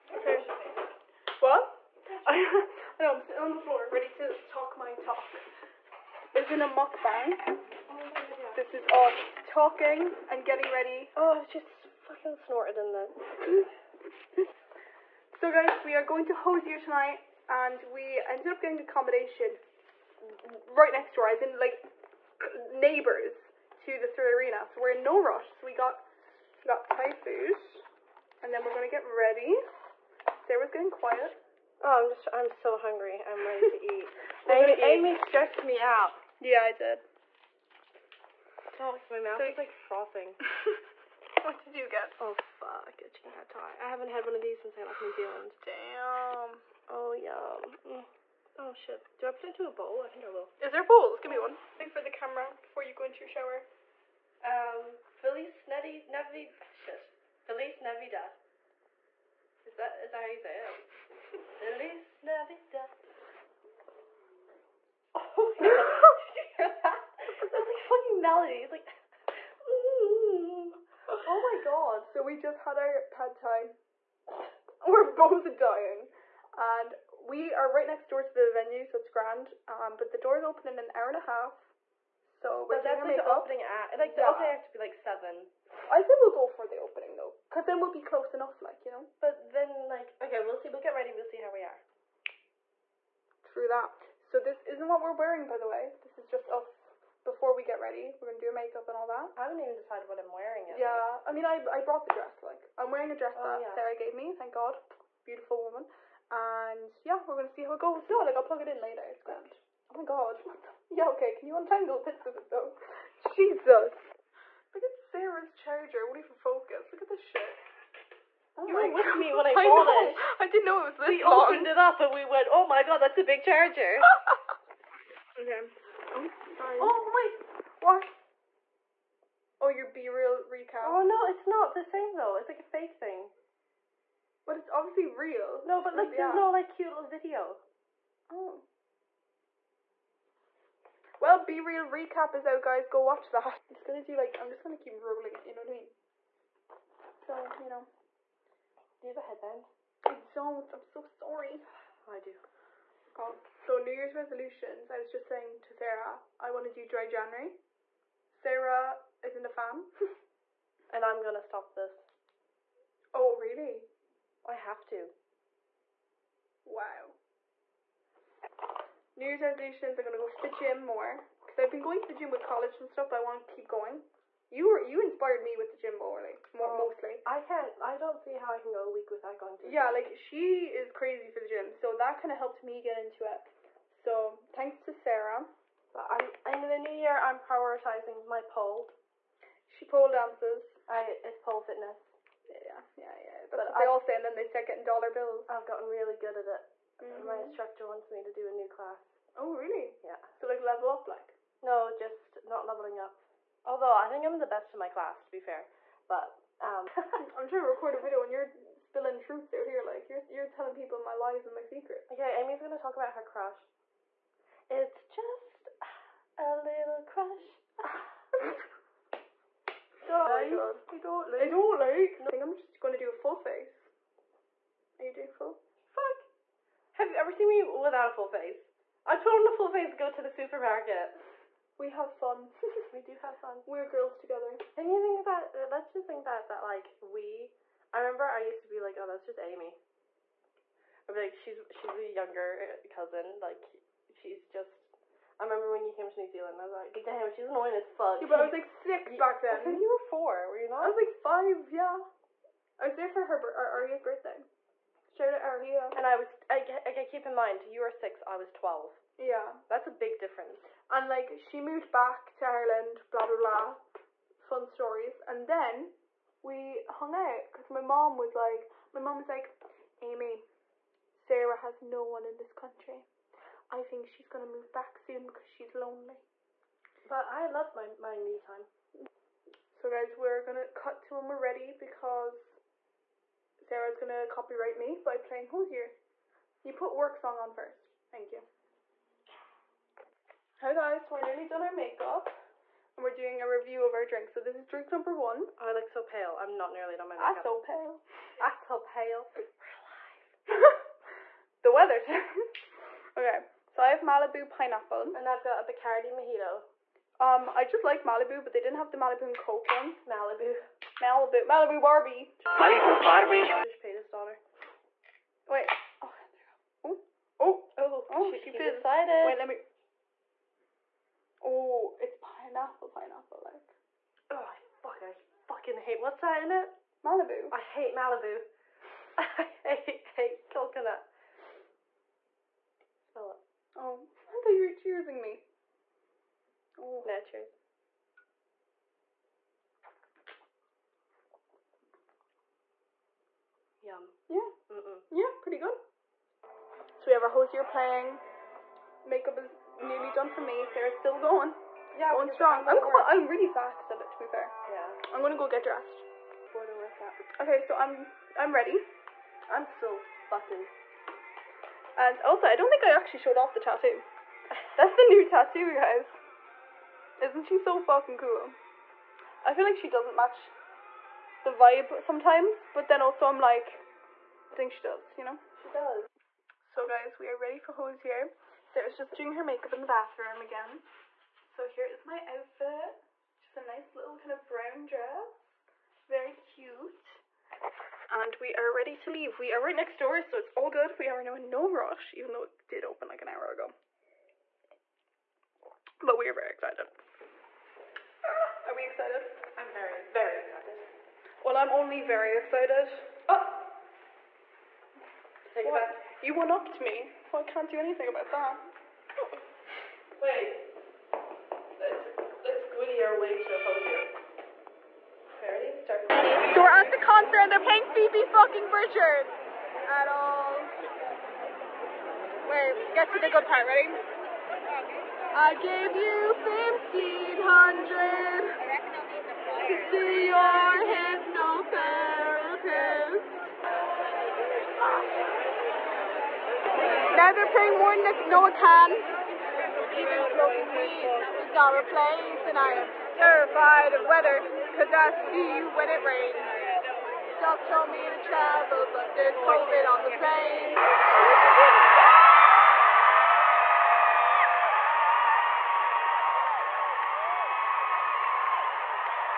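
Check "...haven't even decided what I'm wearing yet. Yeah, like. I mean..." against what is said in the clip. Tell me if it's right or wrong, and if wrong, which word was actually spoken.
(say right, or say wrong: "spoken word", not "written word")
right.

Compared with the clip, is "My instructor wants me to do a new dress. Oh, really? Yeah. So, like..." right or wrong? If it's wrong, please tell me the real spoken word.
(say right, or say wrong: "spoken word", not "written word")
wrong: "class", not "dress".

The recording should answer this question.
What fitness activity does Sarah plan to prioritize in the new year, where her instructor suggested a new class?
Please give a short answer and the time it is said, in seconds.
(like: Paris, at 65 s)
Pole fitness, at 191 s.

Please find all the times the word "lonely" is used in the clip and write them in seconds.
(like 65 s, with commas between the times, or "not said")
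275 s.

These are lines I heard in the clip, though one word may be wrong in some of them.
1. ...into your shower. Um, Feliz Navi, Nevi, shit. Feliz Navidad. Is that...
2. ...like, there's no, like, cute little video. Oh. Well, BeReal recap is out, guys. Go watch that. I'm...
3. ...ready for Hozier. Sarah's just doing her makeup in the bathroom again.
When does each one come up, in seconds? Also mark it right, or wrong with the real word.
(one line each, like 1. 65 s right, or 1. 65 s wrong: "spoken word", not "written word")
1. 53 s right
2. 135 s right
3. 377 s right.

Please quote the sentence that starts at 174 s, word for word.
You were you inspired me with the gym more, like more, oh, mostly.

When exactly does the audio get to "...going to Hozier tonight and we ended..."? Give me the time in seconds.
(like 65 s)
16 s.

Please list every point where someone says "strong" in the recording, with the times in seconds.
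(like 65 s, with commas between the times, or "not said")
352 s.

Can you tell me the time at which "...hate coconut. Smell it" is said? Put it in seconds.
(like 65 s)
330 s.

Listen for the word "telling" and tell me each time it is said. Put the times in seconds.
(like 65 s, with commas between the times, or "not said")
210 s.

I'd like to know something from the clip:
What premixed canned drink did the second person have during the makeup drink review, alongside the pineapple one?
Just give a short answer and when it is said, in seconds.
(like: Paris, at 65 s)
Bacardi mojito, at 305 s.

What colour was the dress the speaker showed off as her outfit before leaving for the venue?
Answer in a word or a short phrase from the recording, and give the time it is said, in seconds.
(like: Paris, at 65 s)
Brown, at 384 s.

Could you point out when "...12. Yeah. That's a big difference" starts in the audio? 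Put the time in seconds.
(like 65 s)
258 s.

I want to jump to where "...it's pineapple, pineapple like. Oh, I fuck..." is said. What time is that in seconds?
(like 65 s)
322 s.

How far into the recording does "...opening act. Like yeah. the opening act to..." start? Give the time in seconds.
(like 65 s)
83 s.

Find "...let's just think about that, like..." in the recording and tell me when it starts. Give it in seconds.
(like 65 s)
235 s.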